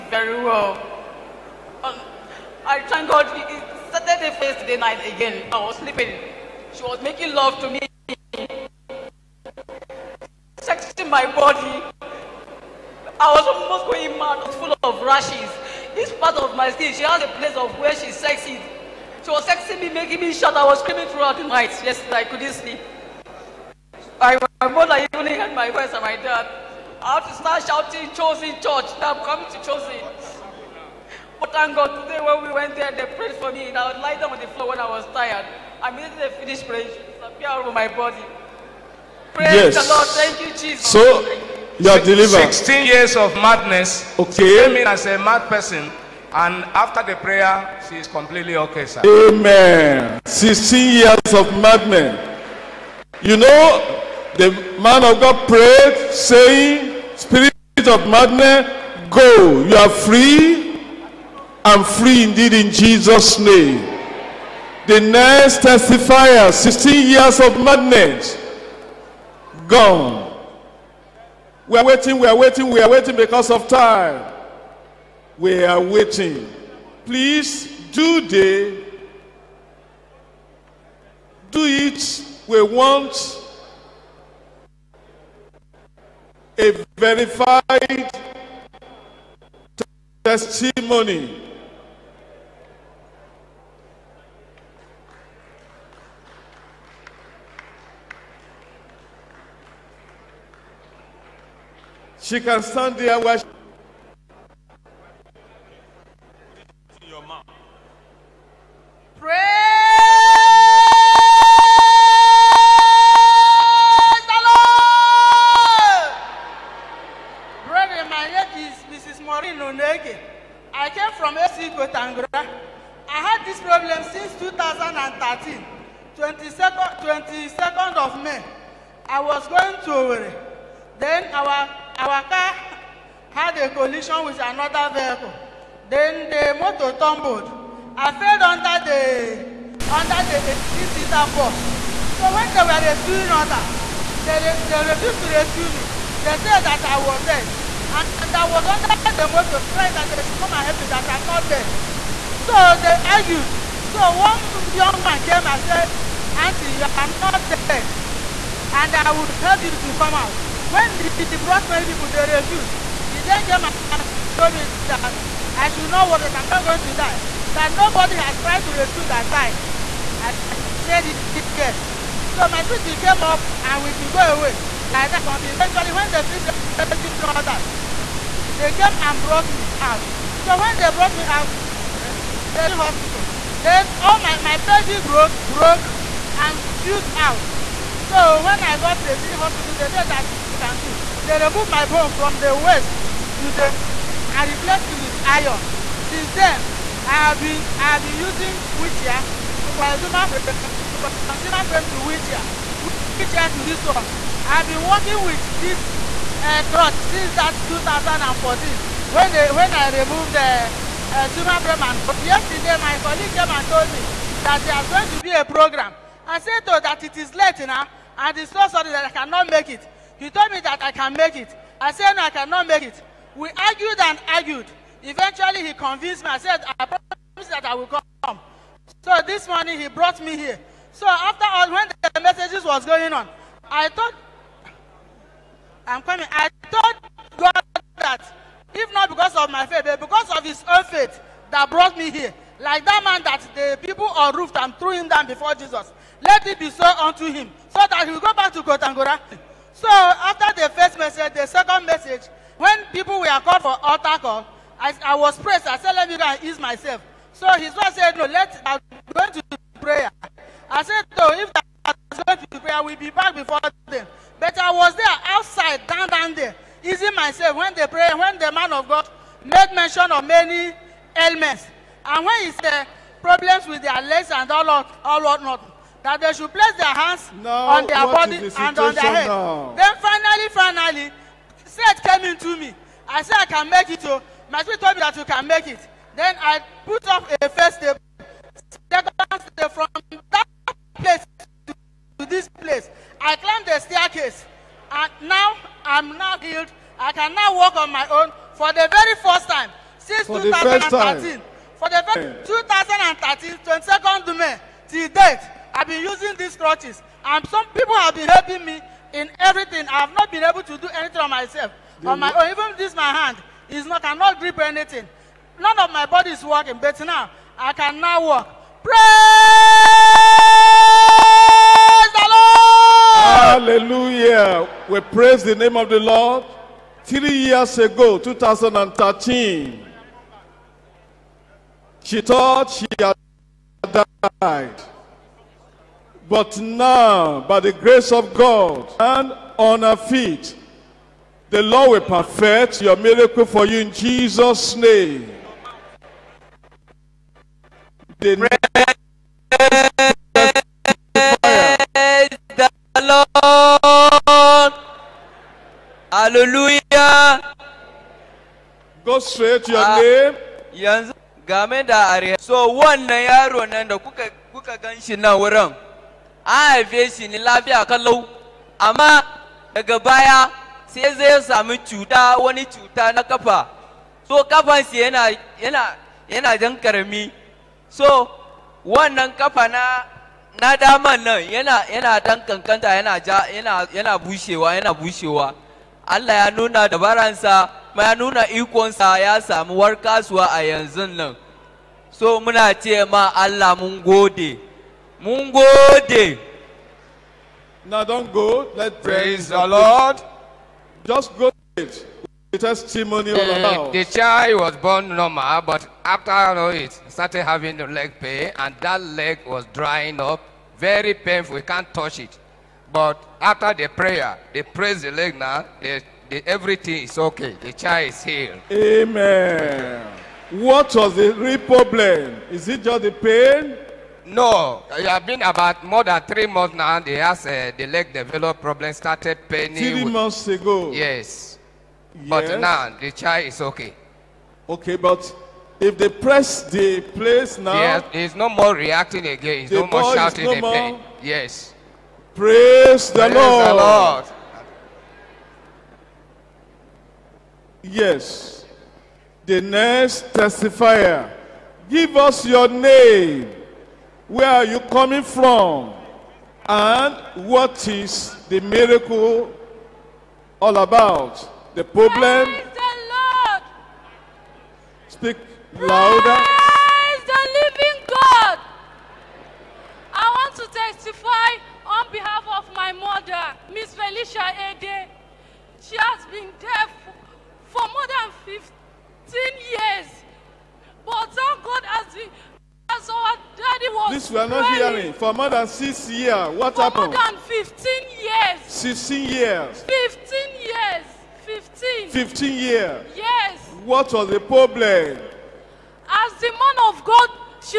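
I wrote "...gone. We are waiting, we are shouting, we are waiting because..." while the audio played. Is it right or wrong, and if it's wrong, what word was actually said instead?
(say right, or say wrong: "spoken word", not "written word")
wrong: "waiting", not "shouting".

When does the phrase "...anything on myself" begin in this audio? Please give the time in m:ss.
5:10.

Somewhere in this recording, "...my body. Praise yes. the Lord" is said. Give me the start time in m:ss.
0:37.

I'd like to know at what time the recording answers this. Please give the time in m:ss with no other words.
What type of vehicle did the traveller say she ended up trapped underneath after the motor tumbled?
2:20.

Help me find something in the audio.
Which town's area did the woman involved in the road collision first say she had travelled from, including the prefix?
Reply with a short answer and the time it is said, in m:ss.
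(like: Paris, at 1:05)
AC Kontagora, at 2:01.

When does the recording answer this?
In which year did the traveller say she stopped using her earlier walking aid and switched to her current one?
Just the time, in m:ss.
3:27.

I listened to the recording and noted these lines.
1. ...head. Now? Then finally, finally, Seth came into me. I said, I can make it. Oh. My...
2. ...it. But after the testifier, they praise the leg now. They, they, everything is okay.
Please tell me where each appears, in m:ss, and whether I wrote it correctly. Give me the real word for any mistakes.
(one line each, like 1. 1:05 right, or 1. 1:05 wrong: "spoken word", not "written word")
1. 4:39 right
2. 6:52 wrong: "prayer", not "testifier".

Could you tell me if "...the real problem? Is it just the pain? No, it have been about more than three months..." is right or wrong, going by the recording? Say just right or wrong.
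right.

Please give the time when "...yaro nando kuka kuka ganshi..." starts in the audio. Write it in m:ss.
6:03.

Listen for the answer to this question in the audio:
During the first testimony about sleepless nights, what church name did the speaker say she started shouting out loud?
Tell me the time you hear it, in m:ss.
0:28.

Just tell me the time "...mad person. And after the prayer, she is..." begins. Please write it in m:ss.
0:45.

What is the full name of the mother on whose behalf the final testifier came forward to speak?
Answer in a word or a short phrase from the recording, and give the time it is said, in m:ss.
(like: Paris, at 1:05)
Felicia Ede, at 7:53.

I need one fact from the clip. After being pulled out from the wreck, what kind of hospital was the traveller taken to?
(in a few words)
Teaching hospital.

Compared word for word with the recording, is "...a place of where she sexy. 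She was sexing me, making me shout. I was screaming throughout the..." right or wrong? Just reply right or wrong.
right.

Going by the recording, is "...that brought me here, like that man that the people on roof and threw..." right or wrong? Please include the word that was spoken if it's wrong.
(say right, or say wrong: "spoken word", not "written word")
right.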